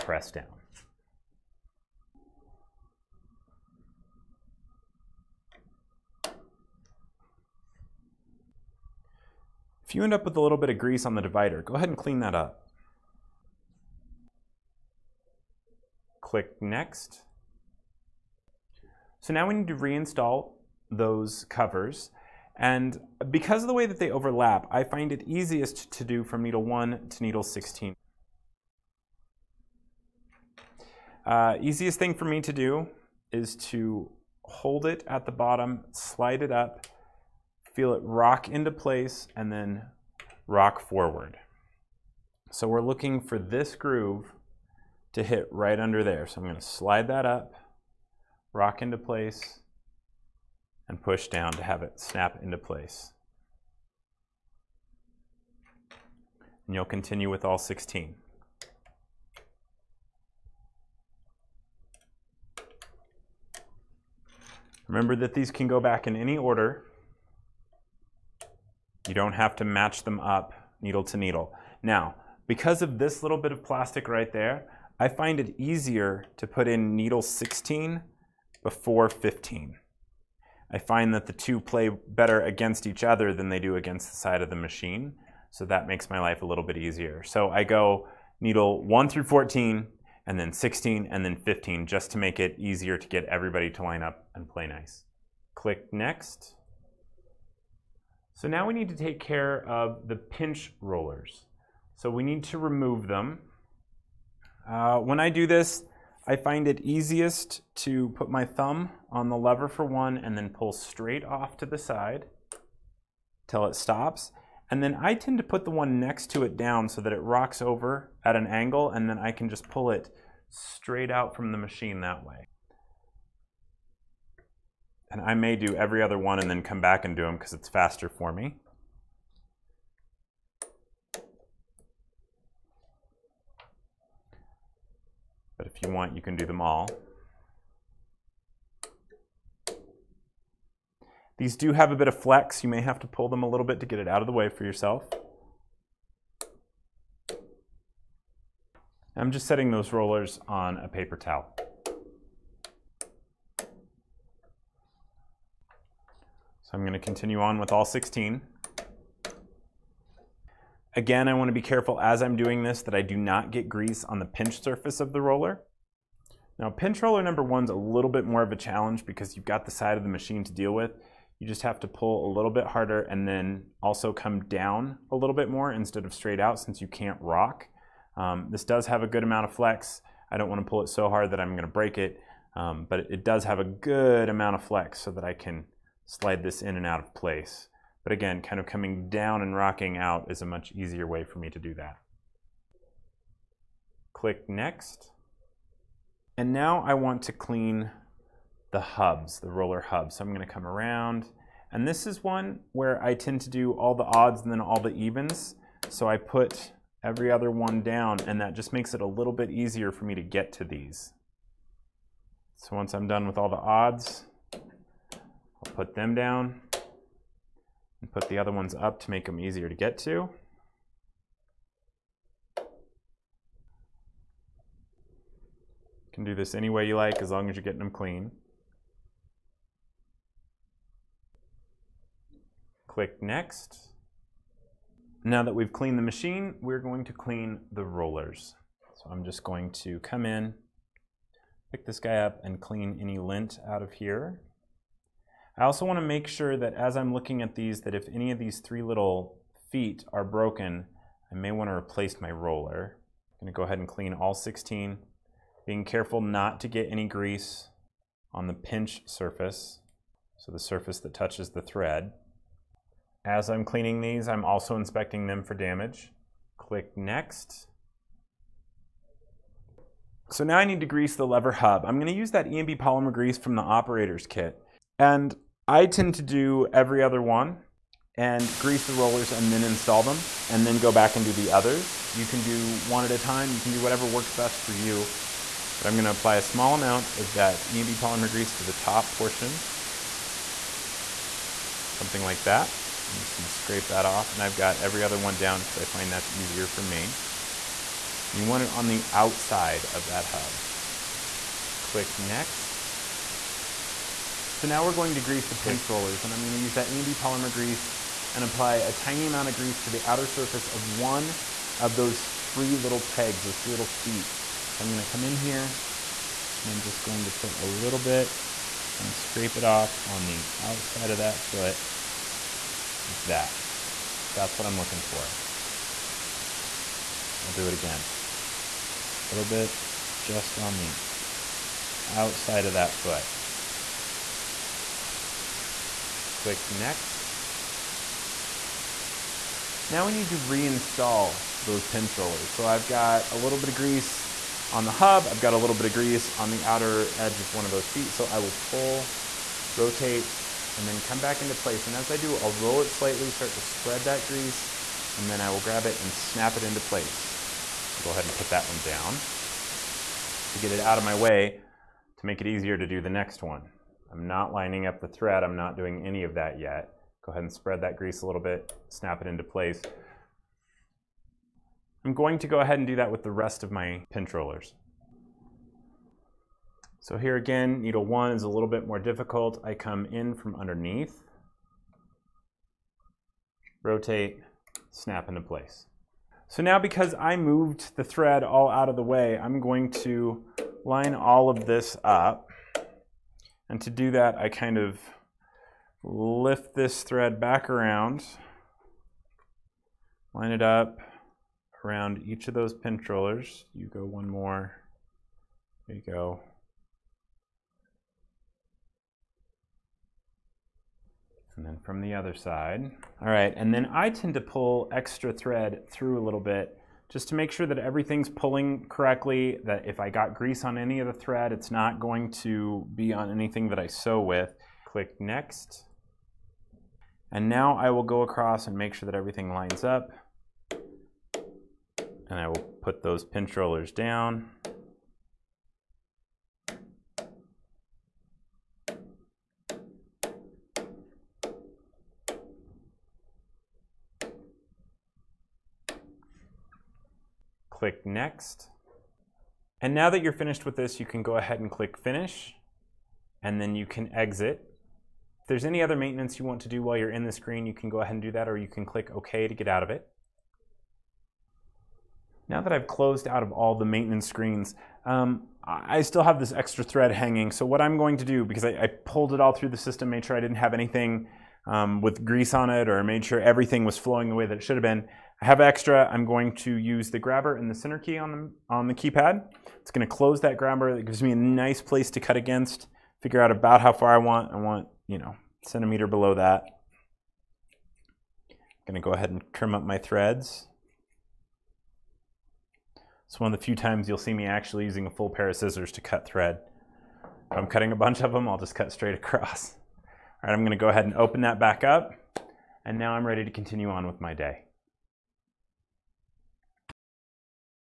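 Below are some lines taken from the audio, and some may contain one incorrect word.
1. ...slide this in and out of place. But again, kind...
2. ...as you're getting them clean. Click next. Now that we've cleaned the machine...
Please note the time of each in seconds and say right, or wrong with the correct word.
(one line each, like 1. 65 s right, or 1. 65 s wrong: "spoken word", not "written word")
1. 186 s right
2. 227 s right.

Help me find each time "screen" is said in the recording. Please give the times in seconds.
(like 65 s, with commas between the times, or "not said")
457 s, 464 s.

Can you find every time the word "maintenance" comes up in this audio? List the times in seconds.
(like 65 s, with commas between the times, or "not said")
455 s, 463 s.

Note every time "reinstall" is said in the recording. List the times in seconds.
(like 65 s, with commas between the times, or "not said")
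19 s, 340 s.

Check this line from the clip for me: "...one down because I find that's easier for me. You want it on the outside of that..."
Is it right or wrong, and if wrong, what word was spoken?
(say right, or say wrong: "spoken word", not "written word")
right.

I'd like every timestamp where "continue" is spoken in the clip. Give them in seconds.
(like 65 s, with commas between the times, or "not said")
56 s, 156 s, 503 s.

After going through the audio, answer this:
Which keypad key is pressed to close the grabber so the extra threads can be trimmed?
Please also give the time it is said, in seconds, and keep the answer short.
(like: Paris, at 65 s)
Center key, at 477 s.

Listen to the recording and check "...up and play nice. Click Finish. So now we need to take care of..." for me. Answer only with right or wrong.
wrong.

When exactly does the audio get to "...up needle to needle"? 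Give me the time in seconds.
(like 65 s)
70 s.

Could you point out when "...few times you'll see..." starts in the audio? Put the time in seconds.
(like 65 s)
493 s.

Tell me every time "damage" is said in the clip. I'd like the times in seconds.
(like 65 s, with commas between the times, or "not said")
265 s.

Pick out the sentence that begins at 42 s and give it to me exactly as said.
So we're looking for this groove to hit right under there.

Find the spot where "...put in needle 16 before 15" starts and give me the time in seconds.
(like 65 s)
76 s.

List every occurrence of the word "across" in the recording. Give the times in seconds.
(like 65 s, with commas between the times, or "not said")
428 s, 499 s.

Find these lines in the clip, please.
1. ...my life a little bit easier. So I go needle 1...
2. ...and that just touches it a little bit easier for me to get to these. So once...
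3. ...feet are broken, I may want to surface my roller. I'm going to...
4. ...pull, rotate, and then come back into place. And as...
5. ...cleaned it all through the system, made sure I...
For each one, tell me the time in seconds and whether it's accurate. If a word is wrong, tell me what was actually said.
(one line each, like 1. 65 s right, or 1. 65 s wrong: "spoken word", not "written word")
1. 86 s right
2. 208 s wrong: "makes", not "touches"
3. 249 s wrong: "replace", not "surface"
4. 348 s right
5. 468 s wrong: "pulled", not "cleaned".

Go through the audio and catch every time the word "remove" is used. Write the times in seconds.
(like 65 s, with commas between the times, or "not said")
102 s.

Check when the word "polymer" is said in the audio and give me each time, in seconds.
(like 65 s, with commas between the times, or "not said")
272 s, 287 s, 307 s.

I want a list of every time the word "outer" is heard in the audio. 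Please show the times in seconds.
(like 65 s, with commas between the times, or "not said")
310 s, 346 s.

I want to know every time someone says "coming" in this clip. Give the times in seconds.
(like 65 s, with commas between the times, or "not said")
188 s.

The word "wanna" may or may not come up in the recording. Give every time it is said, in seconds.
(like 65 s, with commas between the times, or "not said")
161 s, 180 s.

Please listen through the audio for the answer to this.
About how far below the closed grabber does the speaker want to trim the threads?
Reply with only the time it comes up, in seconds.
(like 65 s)
485 s.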